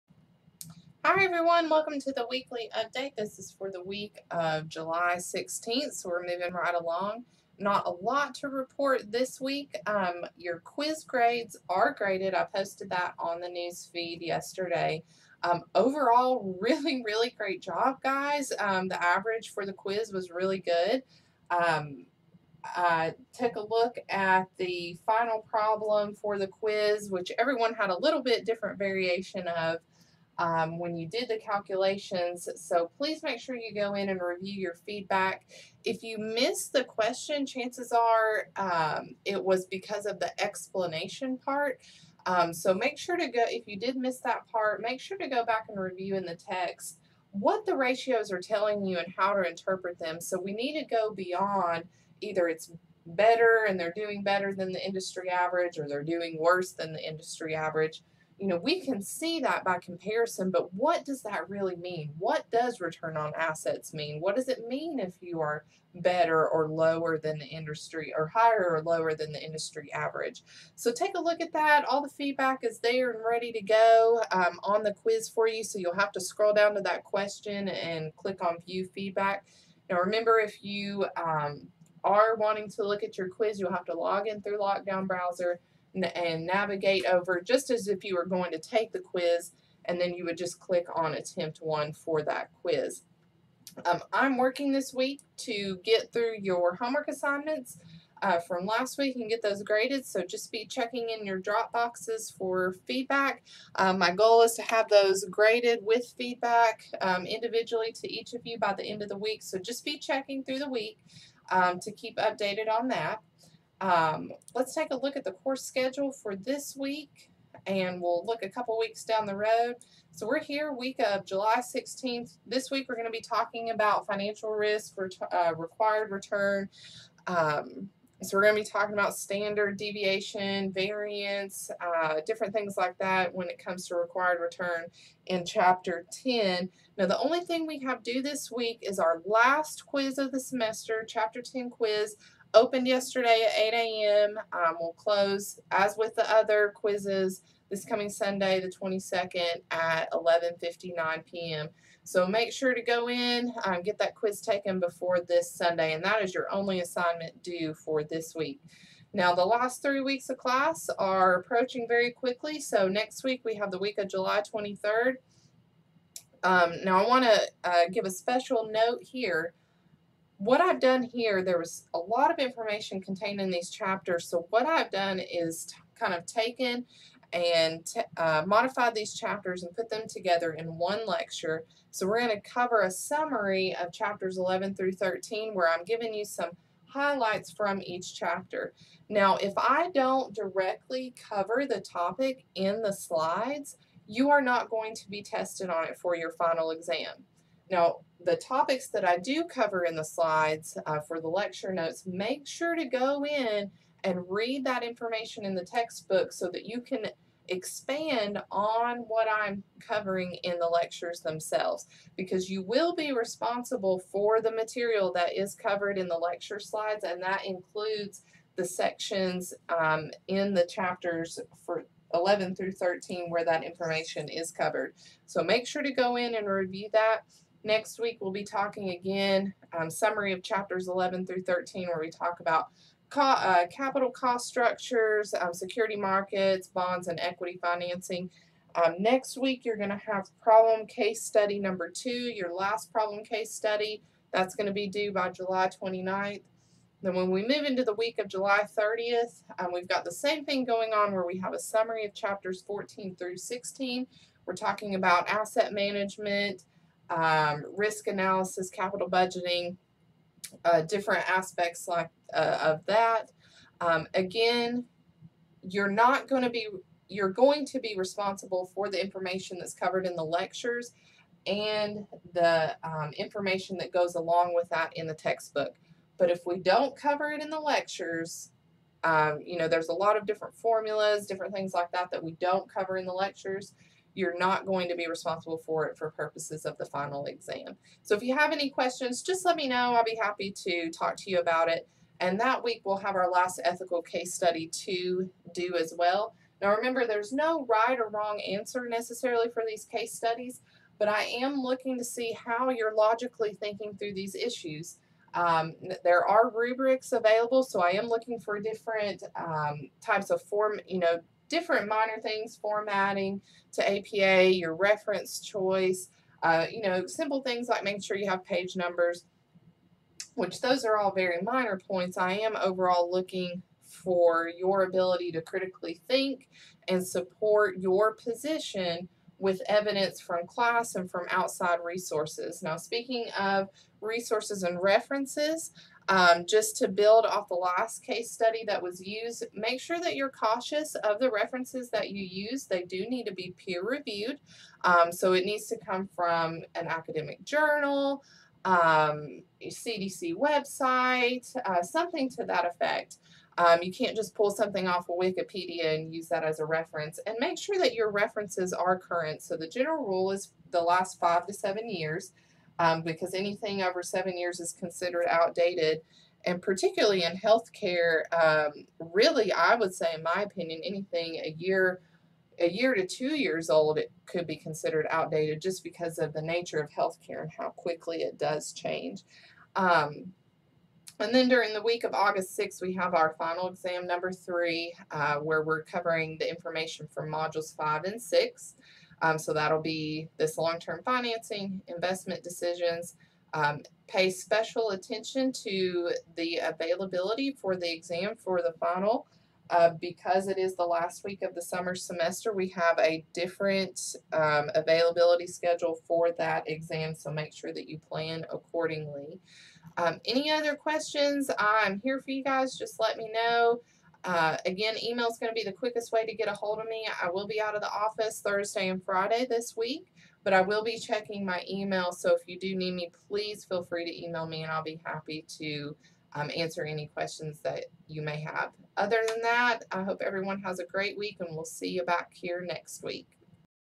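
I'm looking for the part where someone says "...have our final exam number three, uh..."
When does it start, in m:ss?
6:22.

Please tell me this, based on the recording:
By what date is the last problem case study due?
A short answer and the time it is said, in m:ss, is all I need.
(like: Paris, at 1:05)
July 29th, at 4:05.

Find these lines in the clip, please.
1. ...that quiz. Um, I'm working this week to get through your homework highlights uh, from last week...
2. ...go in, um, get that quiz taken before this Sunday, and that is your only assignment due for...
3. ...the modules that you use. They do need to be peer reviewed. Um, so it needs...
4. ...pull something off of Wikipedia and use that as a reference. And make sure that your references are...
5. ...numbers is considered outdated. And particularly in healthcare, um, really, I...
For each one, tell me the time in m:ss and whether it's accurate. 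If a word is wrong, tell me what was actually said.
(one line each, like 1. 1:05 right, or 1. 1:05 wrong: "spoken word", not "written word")
1. 1:32 wrong: "assignments", not "highlights"
2. 2:32 right
3. 5:41 wrong: "references", not "modules"
4. 5:54 right
5. 6:04 wrong: "years", not "numbers".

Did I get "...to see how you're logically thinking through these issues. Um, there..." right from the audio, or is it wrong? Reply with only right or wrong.
right.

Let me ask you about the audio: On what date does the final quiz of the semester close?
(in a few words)
Sunday the 22nd.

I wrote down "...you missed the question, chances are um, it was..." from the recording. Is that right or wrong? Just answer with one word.
right.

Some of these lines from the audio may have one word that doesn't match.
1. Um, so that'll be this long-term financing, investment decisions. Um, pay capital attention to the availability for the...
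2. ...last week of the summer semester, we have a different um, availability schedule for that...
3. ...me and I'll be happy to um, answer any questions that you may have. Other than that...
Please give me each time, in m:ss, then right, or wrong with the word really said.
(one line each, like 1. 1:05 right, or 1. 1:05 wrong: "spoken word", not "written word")
1. 6:29 wrong: "special", not "capital"
2. 6:40 right
3. 7:04 right.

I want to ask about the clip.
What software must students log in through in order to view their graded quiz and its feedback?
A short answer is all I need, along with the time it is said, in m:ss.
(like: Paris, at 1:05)
Lockdown Browser, at 1:24.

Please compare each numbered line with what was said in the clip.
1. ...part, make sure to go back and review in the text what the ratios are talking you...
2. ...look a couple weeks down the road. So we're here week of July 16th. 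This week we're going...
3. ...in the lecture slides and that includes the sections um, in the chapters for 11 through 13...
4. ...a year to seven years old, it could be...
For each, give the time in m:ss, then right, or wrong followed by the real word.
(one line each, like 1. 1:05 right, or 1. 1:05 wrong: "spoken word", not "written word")
1. 0:44 wrong: "telling", not "talking"
2. 1:58 right
3. 3:35 right
4. 6:12 wrong: "two", not "seven".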